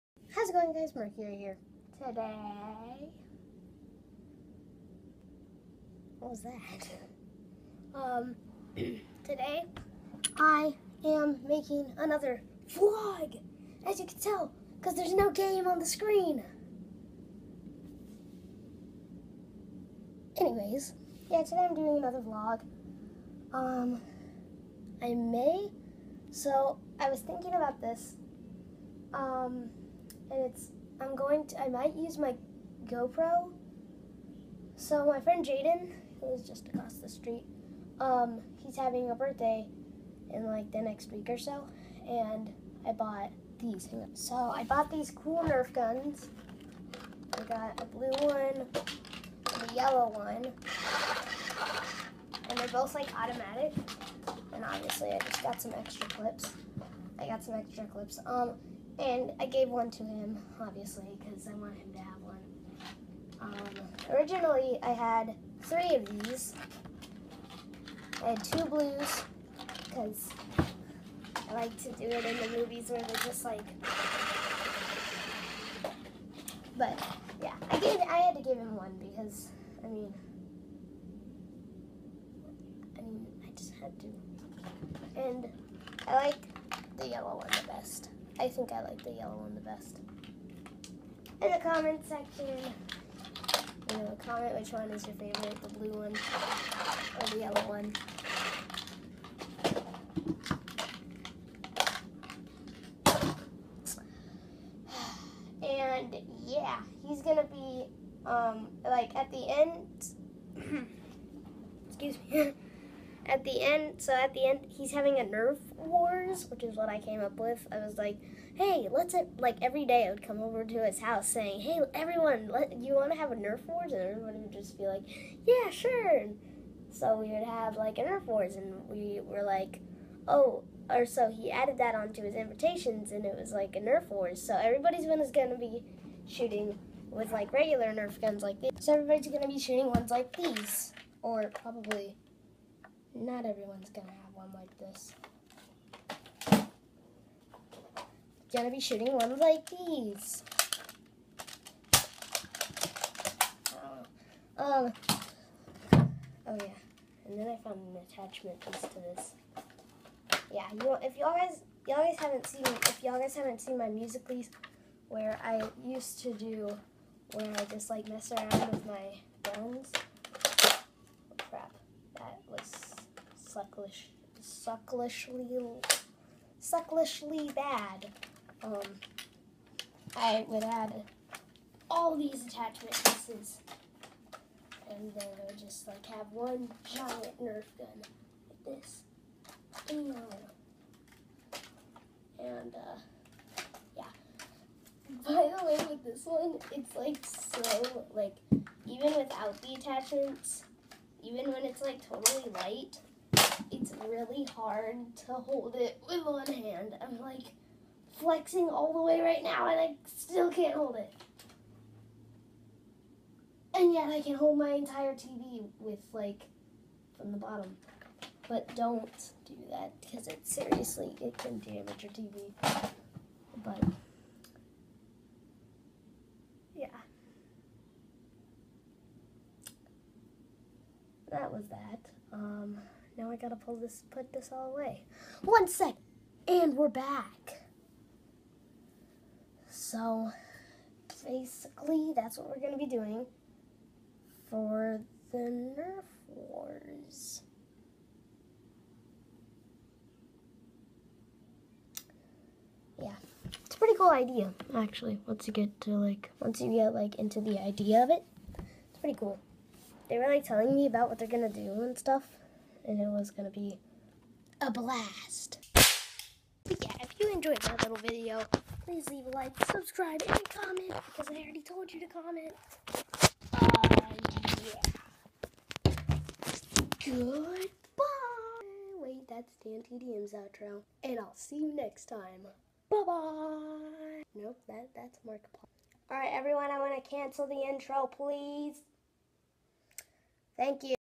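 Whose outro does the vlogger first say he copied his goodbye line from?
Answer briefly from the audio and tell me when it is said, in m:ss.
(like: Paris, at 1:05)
DanTDM, at 4:39.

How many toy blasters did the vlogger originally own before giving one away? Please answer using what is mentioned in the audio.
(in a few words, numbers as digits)
3.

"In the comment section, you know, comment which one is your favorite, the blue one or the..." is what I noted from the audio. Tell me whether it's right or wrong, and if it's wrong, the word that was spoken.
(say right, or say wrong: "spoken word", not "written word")
right.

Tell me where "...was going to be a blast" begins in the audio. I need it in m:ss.
4:23.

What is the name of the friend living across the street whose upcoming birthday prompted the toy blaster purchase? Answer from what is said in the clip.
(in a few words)
Jaden.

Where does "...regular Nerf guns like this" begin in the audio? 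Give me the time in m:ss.
2:17.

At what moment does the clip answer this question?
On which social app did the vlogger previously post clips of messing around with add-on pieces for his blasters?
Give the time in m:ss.
2:43.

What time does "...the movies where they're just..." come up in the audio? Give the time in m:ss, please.
1:12.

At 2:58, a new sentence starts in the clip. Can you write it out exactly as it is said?
Um, I would add all these attachment pieces, and then I would just like have one giant Nerf gun like this.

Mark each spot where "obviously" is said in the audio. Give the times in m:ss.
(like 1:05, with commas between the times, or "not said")
0:54, 1:00.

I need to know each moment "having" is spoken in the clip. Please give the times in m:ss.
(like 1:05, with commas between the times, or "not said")
0:38, 1:54.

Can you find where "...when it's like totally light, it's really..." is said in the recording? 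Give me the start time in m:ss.
3:21.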